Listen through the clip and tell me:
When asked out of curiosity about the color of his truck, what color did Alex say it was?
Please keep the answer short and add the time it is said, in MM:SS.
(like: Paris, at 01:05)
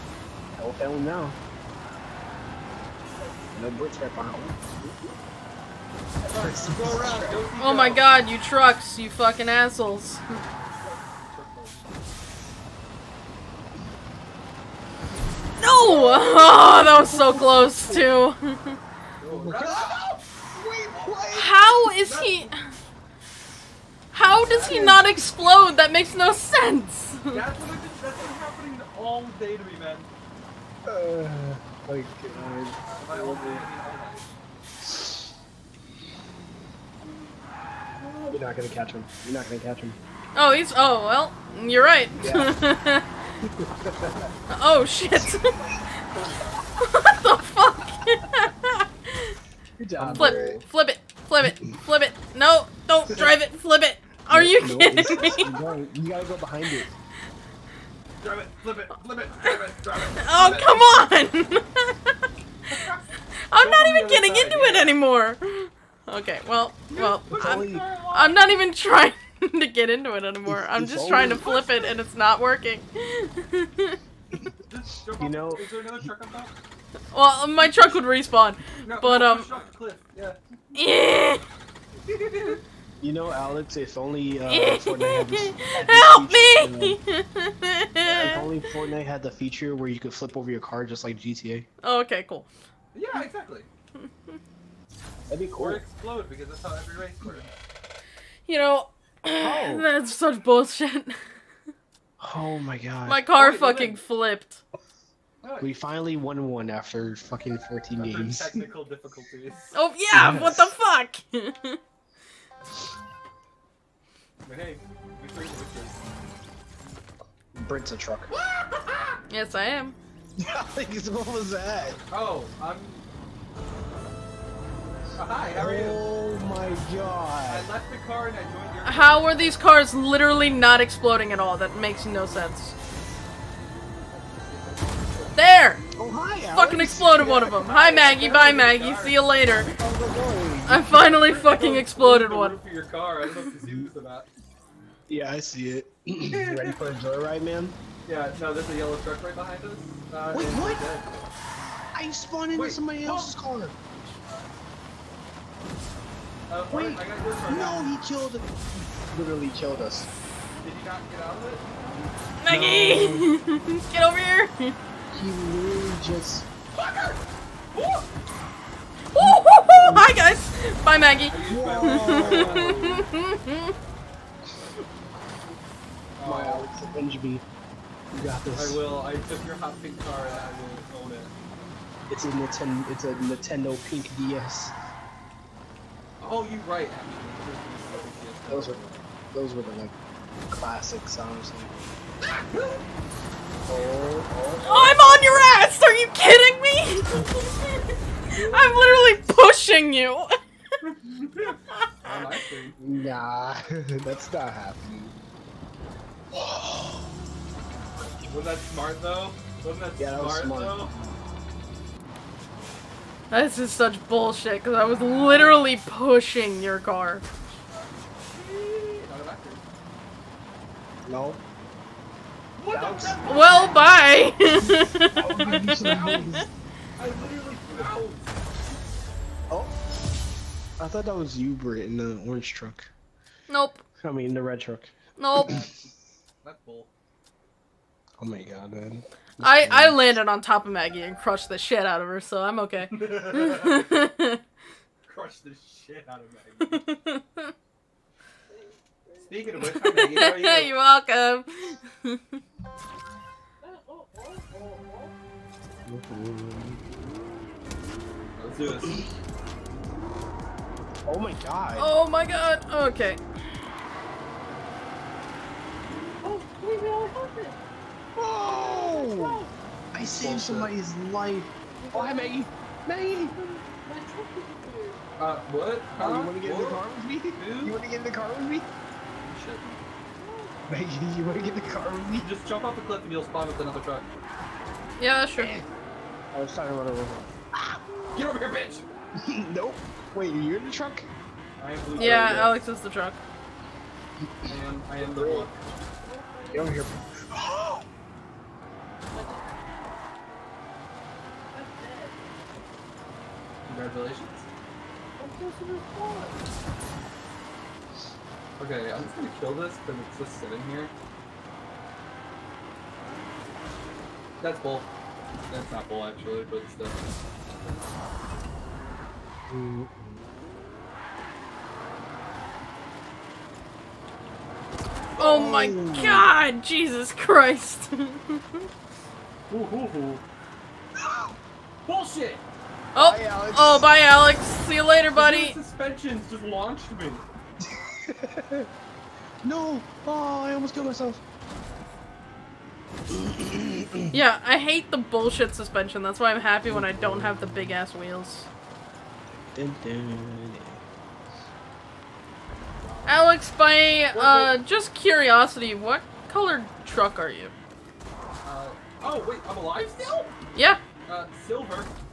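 Silver, at 06:01.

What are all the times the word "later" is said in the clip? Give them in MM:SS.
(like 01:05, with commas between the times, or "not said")
02:19, 05:34.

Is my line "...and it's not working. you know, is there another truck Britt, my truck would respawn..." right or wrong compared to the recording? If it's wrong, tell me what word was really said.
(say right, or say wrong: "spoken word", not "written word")
wrong: "Well", not "Britt".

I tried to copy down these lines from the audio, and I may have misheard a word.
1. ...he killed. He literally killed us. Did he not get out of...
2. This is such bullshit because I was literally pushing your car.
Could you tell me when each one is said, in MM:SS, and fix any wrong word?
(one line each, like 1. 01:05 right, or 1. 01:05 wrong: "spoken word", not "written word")
1. 02:37 right
2. 03:33 right.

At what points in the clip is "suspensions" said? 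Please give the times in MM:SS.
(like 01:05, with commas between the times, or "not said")
05:35, 05:45.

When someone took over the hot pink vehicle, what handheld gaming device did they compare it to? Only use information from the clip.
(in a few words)
Nintendo Pink DS.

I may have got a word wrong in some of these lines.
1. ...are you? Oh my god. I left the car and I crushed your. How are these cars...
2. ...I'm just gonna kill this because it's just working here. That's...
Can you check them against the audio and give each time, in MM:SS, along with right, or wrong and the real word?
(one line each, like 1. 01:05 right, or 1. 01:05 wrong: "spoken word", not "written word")
1. 02:05 wrong: "joined", not "crushed"
2. 05:08 wrong: "sitting", not "working".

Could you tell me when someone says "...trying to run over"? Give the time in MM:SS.
04:46.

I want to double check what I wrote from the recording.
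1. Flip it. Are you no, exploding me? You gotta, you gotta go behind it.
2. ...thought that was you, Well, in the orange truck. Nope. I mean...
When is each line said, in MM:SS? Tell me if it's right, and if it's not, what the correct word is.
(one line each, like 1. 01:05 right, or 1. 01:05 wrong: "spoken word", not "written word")
1. 00:53 wrong: "kidding", not "exploding"
2. 03:50 wrong: "Britt", not "Well".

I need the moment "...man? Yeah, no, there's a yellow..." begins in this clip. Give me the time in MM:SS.
02:27.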